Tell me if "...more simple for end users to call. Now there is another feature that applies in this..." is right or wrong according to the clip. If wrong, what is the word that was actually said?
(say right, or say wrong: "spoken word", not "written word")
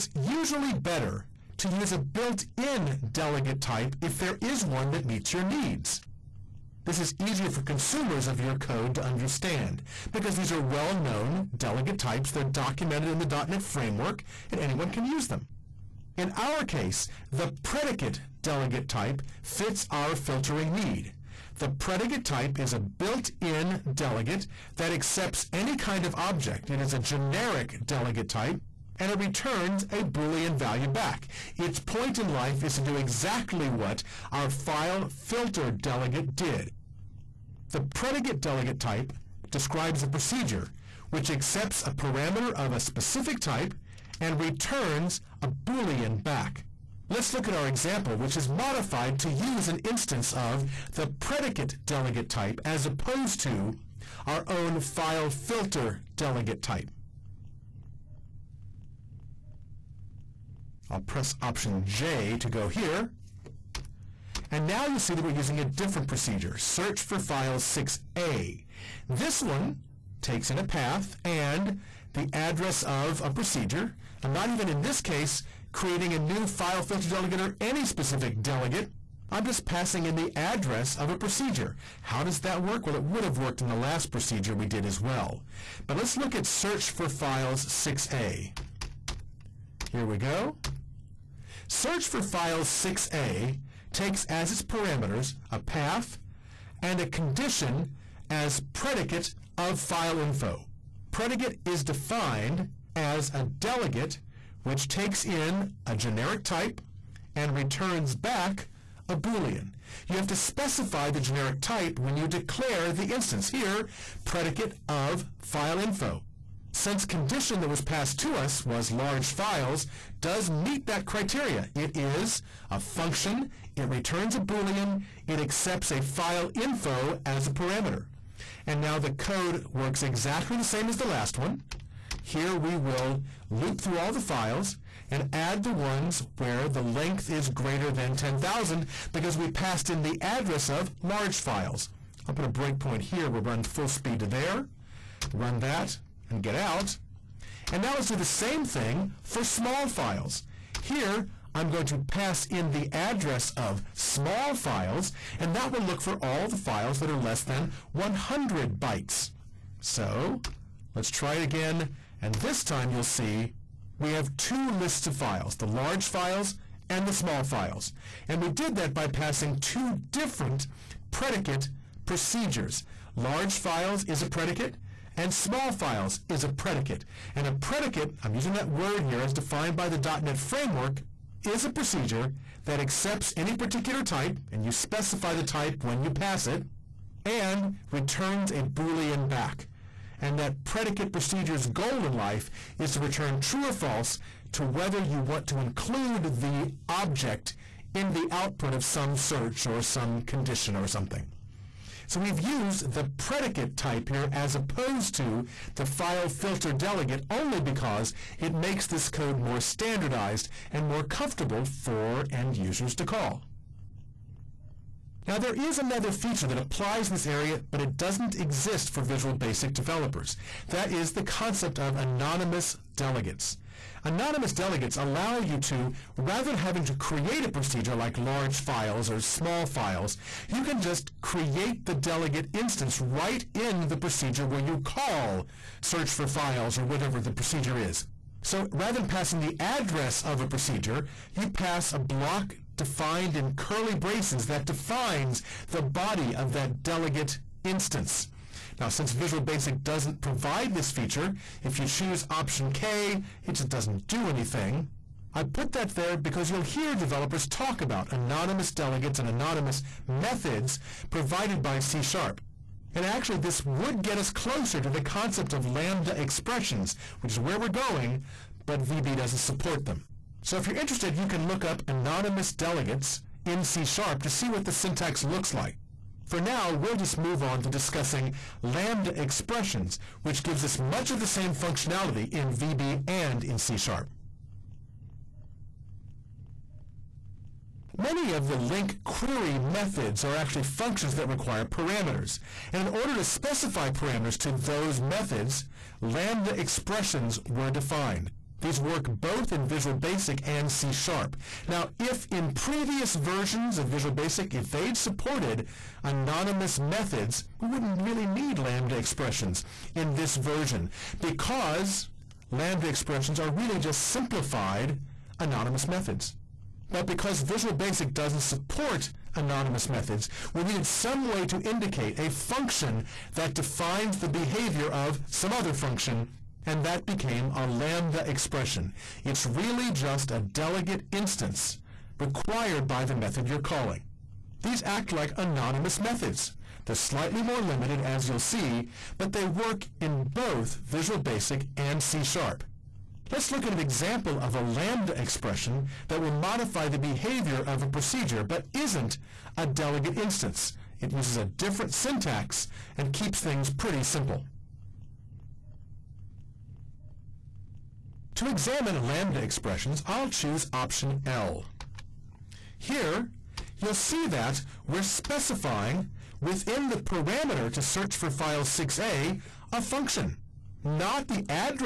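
wrong: "comfortable", not "simple".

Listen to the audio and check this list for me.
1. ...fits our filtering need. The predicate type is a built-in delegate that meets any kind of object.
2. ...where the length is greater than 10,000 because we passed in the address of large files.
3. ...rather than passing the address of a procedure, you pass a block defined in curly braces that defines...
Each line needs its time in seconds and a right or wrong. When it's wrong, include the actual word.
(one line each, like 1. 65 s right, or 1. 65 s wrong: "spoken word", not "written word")
1. 19 s wrong: "accepts", not "meets"
2. 136 s right
3. 238 s right.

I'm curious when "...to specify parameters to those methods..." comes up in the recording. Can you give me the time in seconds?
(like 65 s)
293 s.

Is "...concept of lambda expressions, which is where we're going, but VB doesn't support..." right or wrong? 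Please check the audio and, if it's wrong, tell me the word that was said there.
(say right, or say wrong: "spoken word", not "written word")
right.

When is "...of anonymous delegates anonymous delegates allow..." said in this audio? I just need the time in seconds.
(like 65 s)
221 s.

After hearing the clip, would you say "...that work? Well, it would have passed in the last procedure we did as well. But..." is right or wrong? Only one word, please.
wrong.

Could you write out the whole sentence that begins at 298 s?
These work both in Visual Basic and C Sharp.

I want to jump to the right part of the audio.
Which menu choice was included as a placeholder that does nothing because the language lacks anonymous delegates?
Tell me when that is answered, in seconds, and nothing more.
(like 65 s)
252 s.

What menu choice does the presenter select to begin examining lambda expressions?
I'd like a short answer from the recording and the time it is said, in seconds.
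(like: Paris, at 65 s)
Option L, at 360 s.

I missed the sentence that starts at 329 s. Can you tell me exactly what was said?
It's really just a delegate instance required by the method you're calling.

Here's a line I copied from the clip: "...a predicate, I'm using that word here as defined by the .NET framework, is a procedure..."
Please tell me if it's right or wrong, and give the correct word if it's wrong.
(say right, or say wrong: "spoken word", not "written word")
right.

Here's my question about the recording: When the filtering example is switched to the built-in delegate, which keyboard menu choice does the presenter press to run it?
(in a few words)
Option J.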